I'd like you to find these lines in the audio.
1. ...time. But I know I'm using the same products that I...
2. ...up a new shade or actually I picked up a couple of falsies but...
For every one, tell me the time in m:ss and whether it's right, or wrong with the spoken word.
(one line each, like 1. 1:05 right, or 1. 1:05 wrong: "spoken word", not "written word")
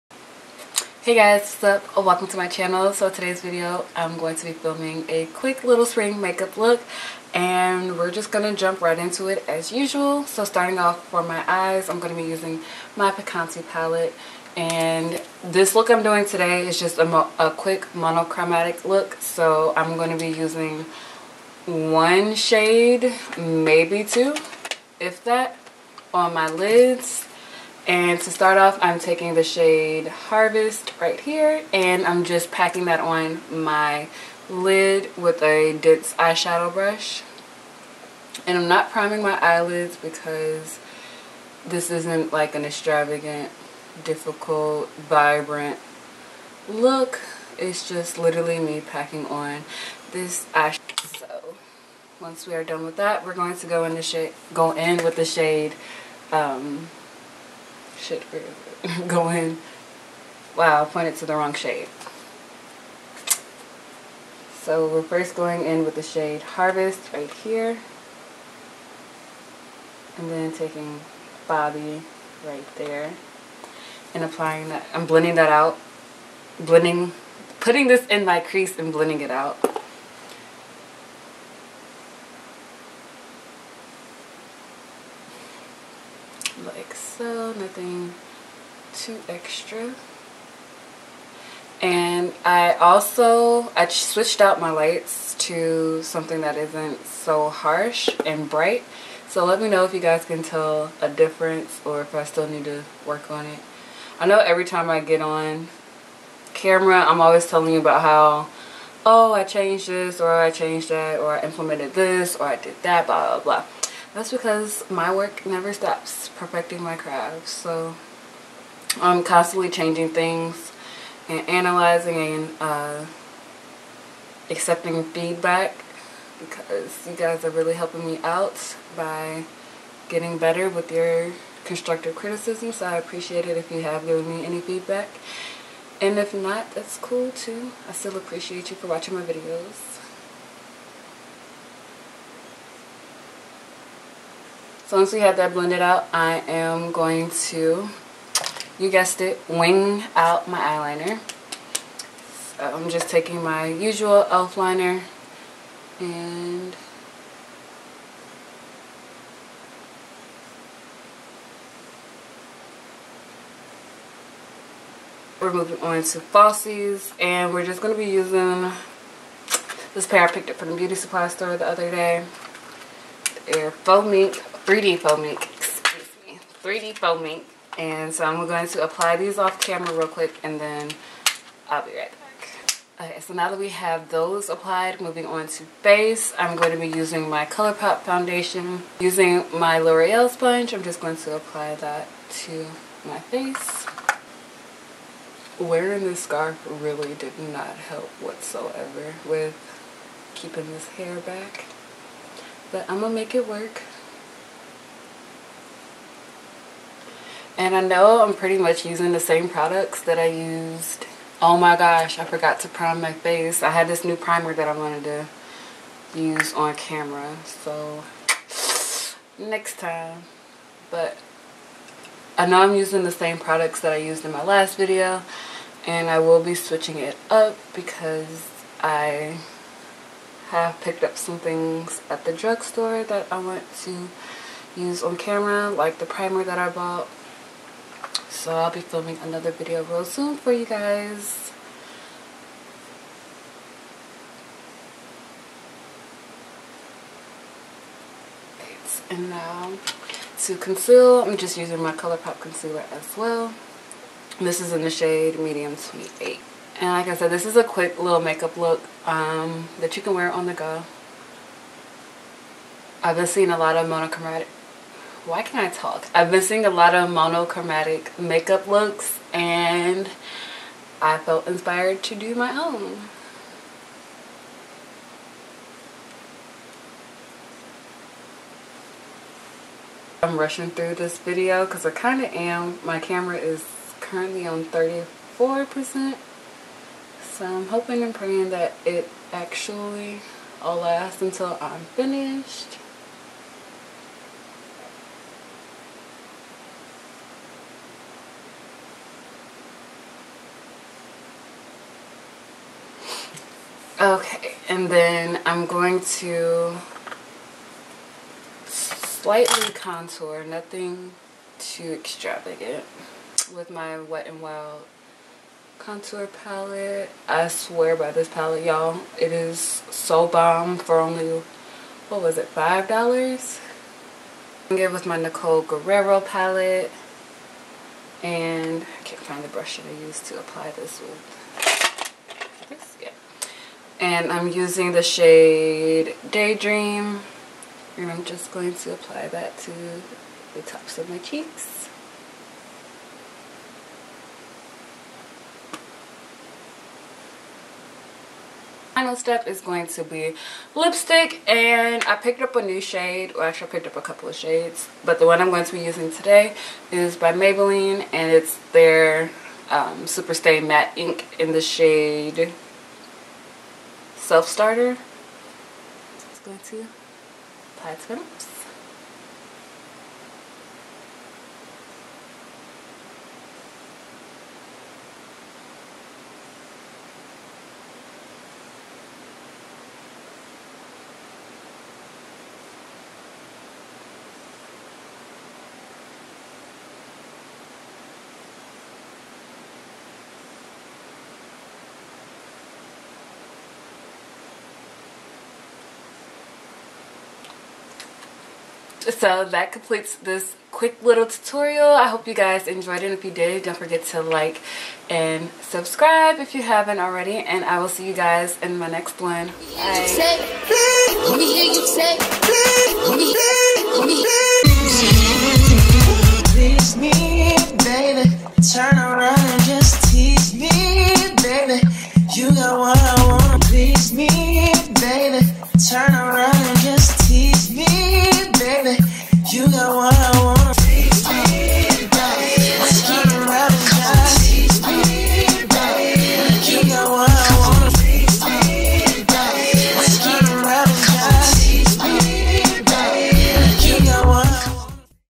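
1. 3:39 right
2. 5:52 wrong: "shades", not "falsies".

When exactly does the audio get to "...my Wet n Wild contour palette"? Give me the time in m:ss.
5:13.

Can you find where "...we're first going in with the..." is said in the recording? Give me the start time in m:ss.
1:04.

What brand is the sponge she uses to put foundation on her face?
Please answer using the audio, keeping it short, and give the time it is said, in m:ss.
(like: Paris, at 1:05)
L'Oreal, at 3:09.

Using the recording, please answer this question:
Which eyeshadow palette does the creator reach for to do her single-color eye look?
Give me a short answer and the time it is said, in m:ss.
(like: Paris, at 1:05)
Picante, at 0:13.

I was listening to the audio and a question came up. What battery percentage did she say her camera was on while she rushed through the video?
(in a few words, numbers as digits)
34%.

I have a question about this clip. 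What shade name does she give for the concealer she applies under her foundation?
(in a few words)
Medium 28.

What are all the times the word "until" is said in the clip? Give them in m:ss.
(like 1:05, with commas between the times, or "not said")
4:51.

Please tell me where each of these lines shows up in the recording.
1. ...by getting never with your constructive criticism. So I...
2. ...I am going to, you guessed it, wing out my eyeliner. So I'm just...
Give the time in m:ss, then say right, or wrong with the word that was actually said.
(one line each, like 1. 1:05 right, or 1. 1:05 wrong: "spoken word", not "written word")
1. 2:08 wrong: "better", not "never"
2. 2:26 right.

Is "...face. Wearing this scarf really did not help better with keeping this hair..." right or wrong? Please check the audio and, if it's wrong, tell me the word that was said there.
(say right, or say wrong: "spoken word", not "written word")
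wrong: "whatsoever", not "better".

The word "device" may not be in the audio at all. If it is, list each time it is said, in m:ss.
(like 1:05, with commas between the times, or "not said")
not said.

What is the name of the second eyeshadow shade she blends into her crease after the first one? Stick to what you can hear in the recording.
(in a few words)
Bobby.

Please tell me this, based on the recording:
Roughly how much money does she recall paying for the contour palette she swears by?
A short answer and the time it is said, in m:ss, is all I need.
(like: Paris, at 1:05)
$5, at 5:22.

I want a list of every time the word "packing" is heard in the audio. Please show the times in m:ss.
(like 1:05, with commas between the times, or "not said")
0:32, 0:48.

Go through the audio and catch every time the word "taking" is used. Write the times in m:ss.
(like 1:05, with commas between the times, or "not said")
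0:28, 1:10, 2:33.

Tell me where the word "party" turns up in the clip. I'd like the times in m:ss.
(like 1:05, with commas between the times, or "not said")
not said.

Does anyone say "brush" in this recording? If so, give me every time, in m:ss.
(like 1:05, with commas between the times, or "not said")
0:36, 5:29.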